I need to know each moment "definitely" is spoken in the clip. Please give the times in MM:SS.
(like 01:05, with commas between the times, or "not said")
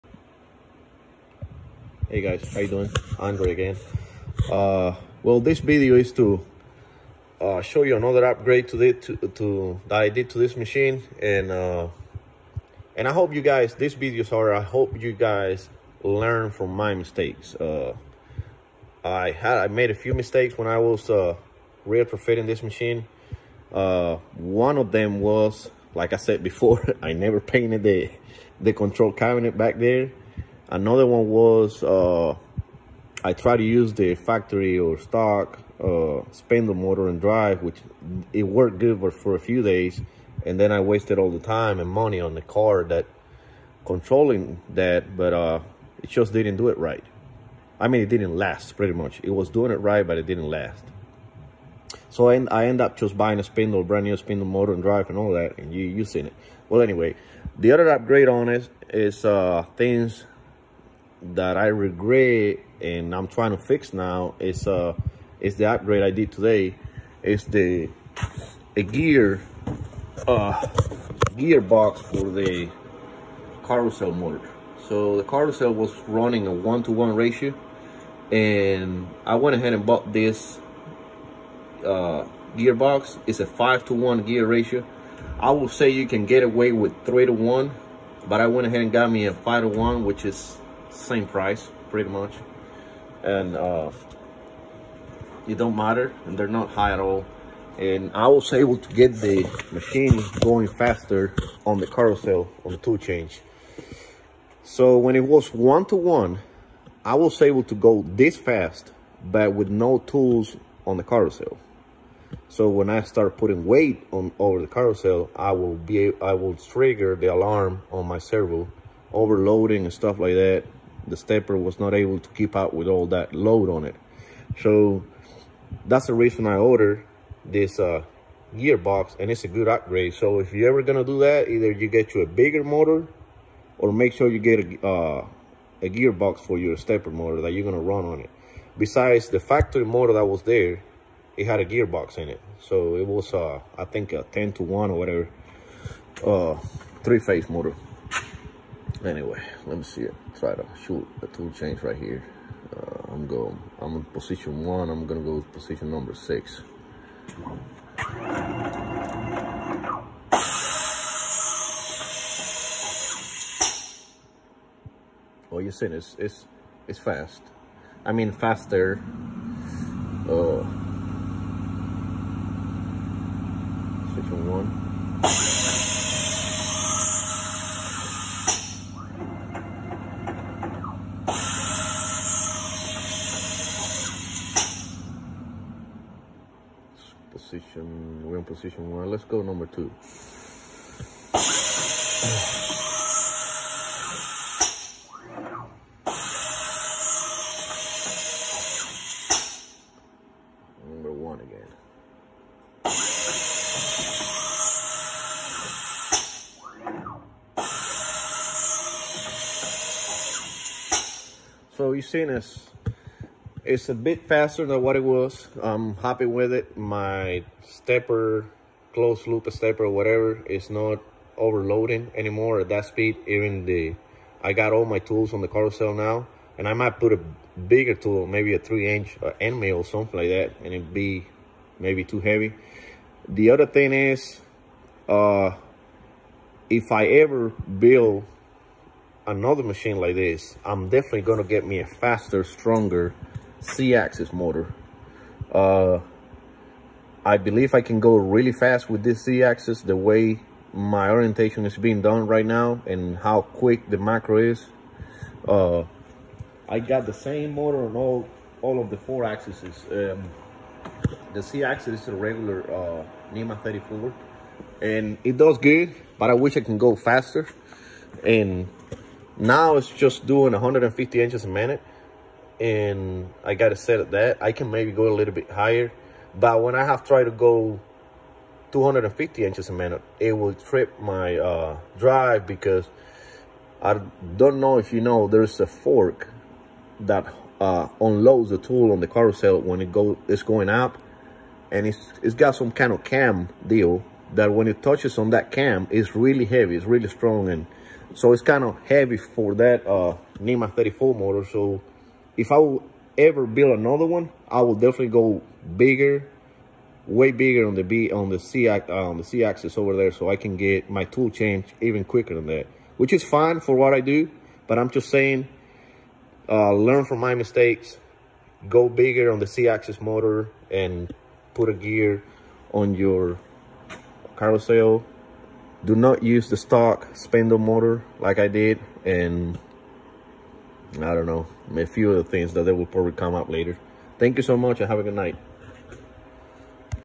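04:00, 05:04.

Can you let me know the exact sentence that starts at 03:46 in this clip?
And I might put a bigger tool, maybe a three inch uh, end mill or something like that.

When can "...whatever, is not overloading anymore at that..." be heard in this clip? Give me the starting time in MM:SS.
03:39.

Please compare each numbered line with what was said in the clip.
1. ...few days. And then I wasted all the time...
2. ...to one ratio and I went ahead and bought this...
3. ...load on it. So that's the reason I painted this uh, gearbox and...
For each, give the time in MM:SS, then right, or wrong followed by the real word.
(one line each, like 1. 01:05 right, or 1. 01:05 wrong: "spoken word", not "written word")
1. 00:39 right
2. 01:16 right
3. 02:03 wrong: "ordered", not "painted".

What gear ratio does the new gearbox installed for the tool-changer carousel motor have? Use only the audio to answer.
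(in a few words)
5 to 1.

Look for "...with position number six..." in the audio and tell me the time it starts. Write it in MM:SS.
02:35.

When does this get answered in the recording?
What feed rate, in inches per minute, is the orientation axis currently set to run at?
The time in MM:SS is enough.
04:30.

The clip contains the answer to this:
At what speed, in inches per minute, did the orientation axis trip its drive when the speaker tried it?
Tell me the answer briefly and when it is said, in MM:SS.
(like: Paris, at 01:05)
250, at 04:38.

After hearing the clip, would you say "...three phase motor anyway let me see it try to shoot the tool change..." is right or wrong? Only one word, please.
right.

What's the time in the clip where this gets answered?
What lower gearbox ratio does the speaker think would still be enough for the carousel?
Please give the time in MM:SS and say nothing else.
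01:27.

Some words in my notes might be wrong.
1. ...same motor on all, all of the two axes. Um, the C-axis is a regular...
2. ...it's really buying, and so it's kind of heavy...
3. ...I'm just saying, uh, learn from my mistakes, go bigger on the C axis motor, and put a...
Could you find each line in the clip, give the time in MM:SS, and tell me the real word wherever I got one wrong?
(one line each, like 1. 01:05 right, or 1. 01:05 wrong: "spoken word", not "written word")
1. 04:17 wrong: "four", not "two"
2. 04:56 wrong: "strong", not "buying"
3. 05:14 right.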